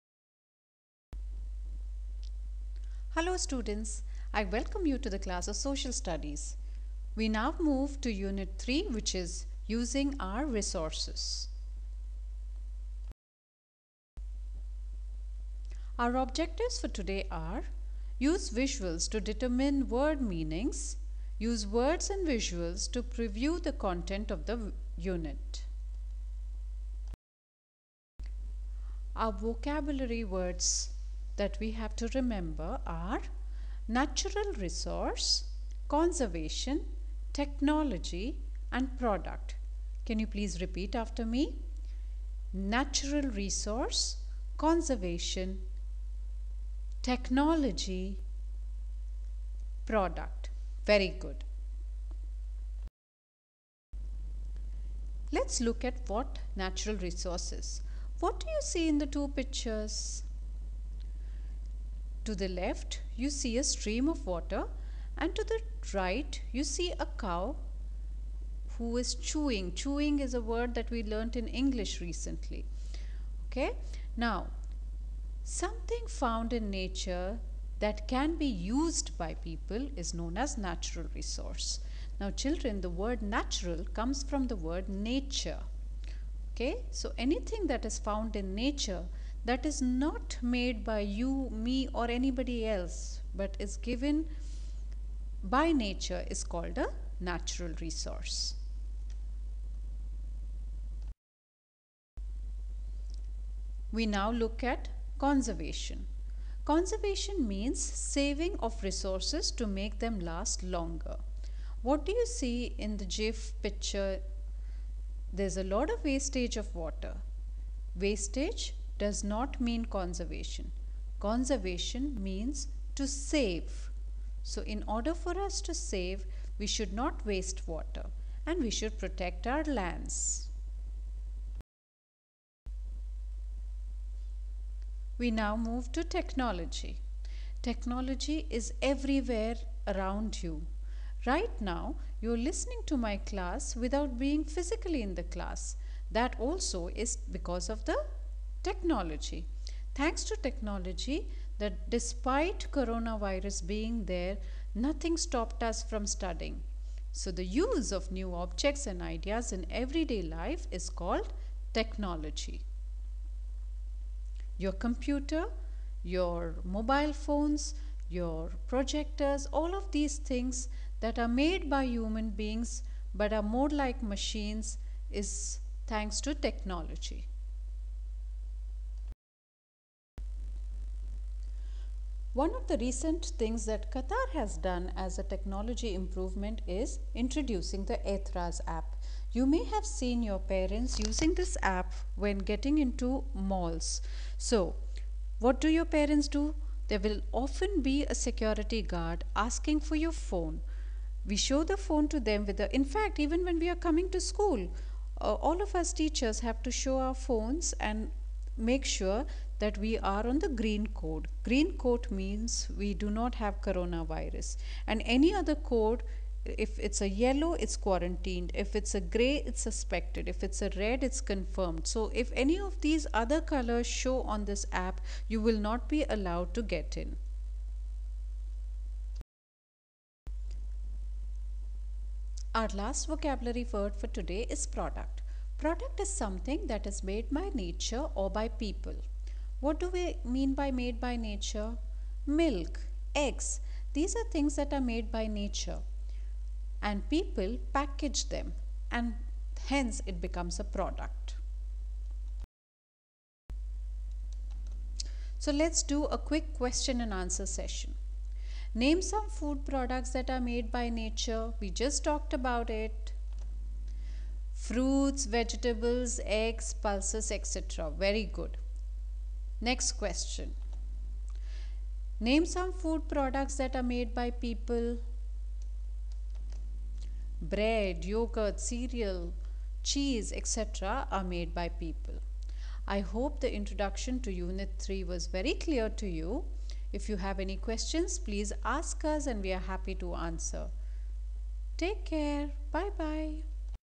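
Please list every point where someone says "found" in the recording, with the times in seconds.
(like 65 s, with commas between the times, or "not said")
76 s, 87 s.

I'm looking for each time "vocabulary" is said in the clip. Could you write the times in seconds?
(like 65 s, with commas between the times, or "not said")
29 s, 233 s.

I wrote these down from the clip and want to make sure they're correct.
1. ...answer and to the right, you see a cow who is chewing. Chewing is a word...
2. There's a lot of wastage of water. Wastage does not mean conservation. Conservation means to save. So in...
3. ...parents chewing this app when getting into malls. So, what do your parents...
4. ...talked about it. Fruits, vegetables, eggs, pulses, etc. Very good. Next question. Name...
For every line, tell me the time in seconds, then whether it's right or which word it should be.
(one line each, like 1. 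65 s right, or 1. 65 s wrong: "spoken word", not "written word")
1. 64 s wrong: "water", not "answer"
2. 115 s right
3. 190 s wrong: "using", not "chewing"
4. 262 s right.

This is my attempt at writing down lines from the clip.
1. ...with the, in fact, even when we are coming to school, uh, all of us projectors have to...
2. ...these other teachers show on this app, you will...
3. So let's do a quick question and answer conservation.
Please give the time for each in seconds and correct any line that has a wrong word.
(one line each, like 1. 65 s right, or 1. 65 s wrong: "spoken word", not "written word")
1. 202 s wrong: "teachers", not "projectors"
2. 222 s wrong: "colors", not "teachers"
3. 255 s wrong: "session", not "conservation".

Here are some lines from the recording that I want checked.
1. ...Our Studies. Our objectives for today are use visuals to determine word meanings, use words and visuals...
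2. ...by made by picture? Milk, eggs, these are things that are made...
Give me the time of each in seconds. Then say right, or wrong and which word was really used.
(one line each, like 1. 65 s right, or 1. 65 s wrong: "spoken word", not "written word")
1. 10 s wrong: "Resources", not "Studies"
2. 240 s wrong: "nature", not "picture".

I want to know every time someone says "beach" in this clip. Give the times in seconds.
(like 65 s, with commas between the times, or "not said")
not said.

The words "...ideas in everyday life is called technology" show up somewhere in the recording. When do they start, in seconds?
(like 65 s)
159 s.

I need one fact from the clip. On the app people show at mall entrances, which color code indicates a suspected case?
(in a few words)
Gray.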